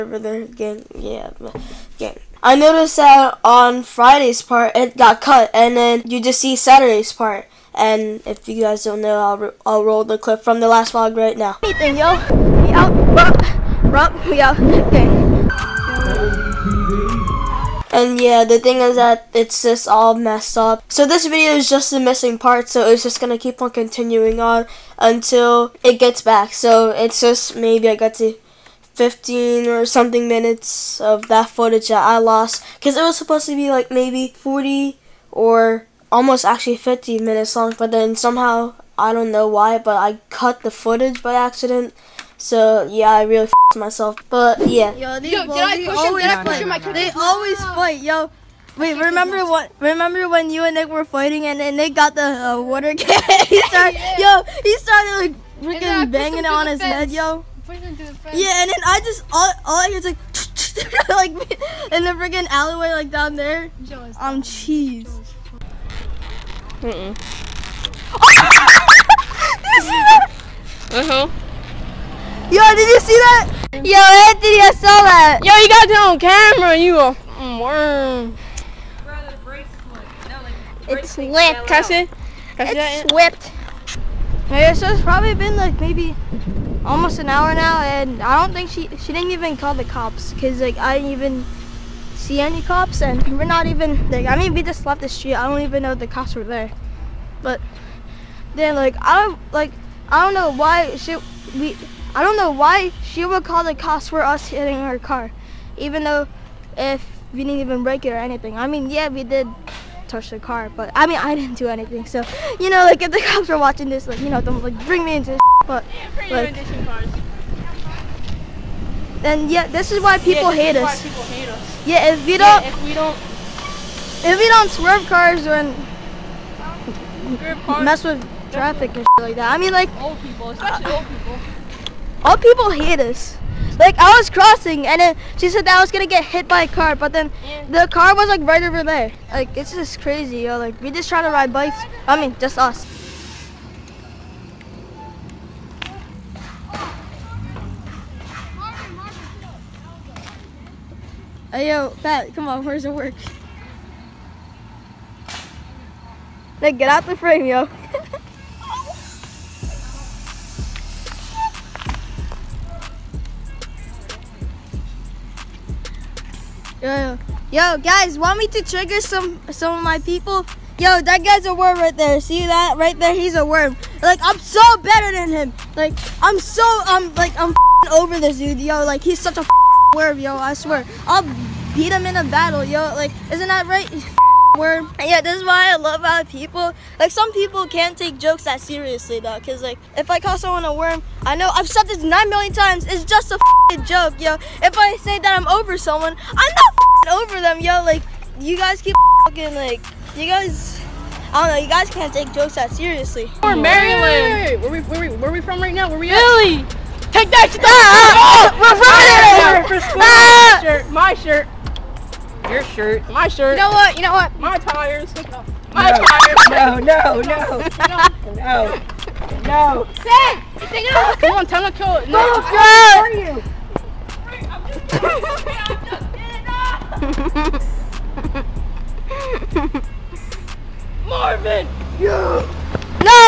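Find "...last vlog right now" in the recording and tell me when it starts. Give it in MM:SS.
00:10.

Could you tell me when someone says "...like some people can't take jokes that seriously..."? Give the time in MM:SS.
03:06.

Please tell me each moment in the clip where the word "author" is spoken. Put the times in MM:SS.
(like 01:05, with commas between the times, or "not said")
not said.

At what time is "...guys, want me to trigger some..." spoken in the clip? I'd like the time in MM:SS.
02:47.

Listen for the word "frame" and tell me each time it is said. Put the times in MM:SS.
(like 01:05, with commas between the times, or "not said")
02:37.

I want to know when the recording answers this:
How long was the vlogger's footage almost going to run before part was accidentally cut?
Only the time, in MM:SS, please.
00:36.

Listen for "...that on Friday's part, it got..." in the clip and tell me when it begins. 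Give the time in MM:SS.
00:02.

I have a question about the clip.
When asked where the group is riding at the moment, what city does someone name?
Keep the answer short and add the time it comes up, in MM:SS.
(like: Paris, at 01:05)
Philly, at 03:26.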